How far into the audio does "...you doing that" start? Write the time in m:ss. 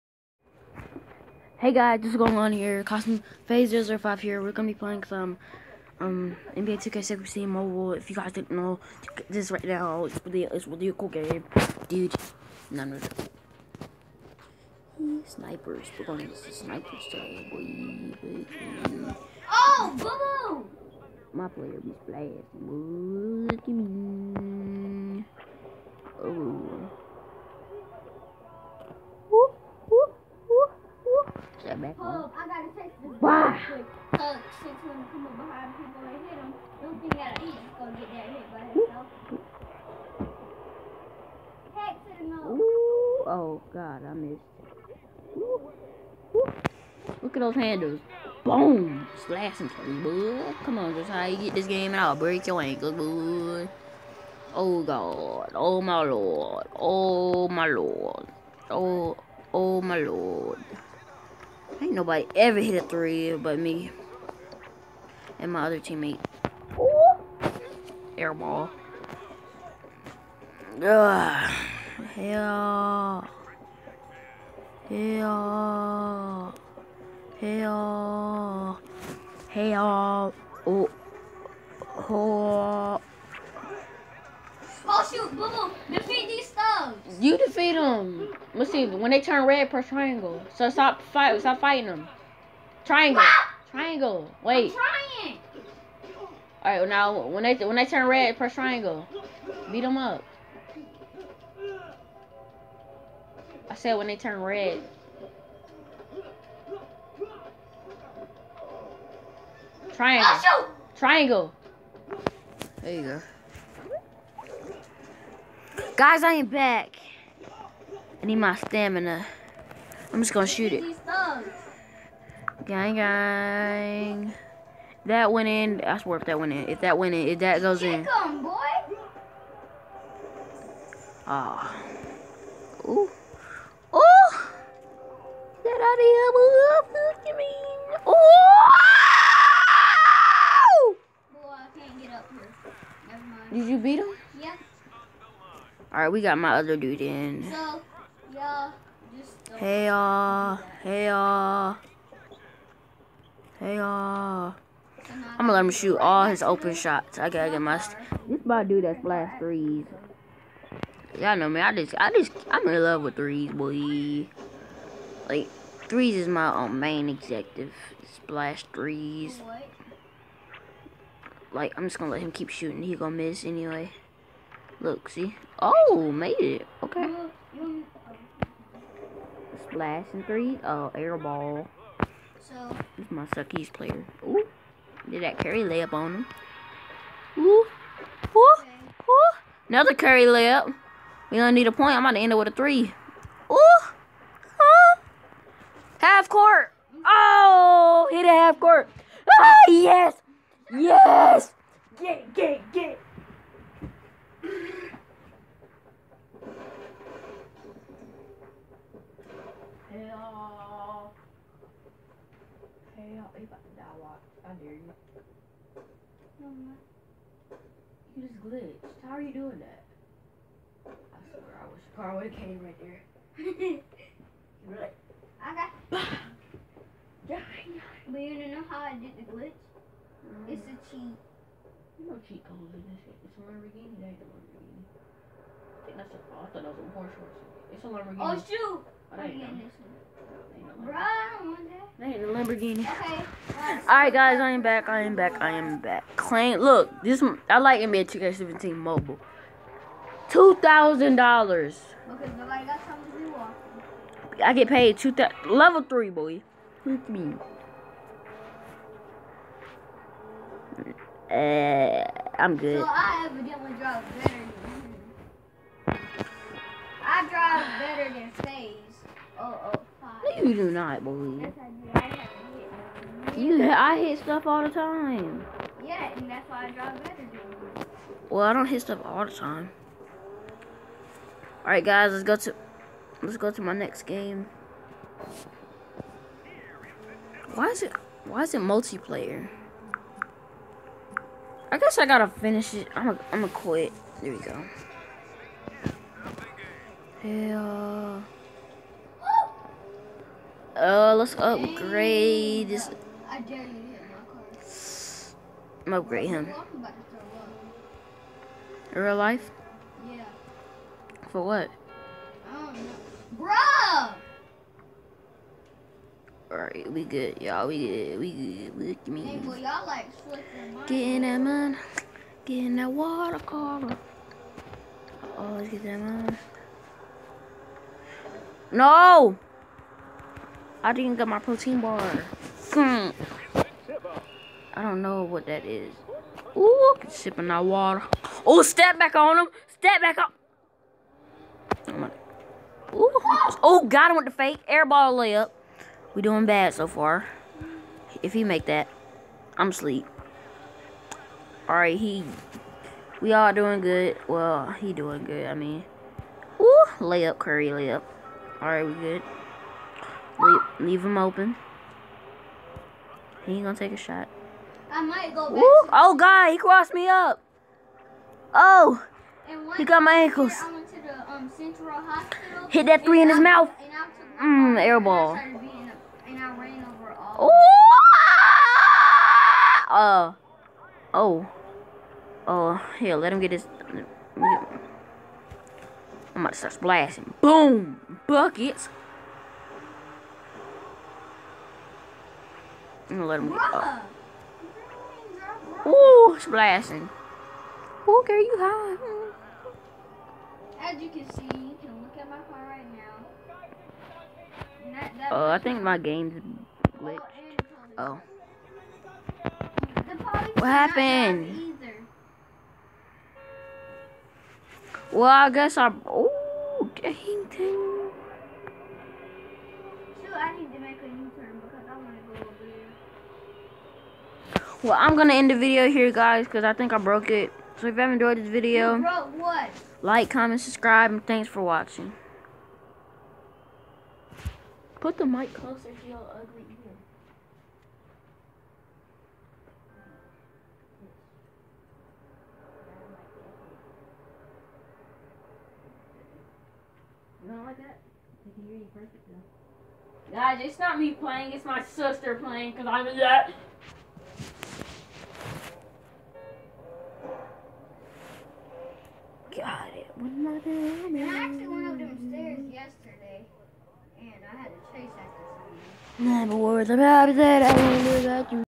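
3:39.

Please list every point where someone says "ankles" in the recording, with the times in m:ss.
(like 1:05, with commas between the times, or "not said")
0:52, 6:10.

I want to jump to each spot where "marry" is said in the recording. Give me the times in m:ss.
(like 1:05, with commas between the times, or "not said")
not said.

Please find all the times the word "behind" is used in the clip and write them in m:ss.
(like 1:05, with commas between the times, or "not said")
0:35.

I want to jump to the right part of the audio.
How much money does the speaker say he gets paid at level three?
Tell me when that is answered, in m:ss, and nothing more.
4:10.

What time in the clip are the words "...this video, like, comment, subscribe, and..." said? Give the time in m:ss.
7:08.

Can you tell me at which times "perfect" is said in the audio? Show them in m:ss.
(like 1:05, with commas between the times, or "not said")
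7:28.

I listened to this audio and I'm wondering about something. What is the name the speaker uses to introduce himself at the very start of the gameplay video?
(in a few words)
Cosmo Phase 05.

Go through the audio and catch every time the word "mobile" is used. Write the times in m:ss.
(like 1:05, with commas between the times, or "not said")
0:07, 4:08.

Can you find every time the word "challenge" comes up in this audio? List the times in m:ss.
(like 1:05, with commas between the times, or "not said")
not said.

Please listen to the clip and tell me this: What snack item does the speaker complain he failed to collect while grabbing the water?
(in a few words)
Protein bar.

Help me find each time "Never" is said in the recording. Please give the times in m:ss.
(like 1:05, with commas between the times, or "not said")
2:23, 7:46.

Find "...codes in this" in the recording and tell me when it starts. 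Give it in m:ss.
3:52.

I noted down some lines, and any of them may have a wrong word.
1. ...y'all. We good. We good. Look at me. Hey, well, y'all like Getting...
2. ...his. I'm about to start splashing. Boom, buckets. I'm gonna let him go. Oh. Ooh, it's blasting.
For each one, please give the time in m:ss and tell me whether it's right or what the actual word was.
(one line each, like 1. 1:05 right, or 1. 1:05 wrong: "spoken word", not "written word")
1. 5:17 right
2. 6:23 right.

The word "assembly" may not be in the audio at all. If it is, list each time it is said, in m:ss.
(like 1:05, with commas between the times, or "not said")
not said.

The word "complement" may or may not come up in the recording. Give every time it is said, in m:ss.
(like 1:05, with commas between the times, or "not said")
not said.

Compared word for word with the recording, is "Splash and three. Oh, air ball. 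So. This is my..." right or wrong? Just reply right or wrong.
right.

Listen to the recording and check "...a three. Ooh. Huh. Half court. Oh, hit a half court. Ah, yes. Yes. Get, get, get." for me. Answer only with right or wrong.
right.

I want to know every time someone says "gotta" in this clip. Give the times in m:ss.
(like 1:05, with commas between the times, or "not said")
0:32, 2:37, 4:52.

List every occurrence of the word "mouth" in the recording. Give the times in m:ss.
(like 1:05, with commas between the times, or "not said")
6:13.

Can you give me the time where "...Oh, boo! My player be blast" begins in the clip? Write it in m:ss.
0:19.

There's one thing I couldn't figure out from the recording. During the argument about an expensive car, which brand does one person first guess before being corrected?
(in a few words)
Porsche.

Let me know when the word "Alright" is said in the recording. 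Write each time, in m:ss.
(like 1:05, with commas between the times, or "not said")
2:25, 4:03, 5:16.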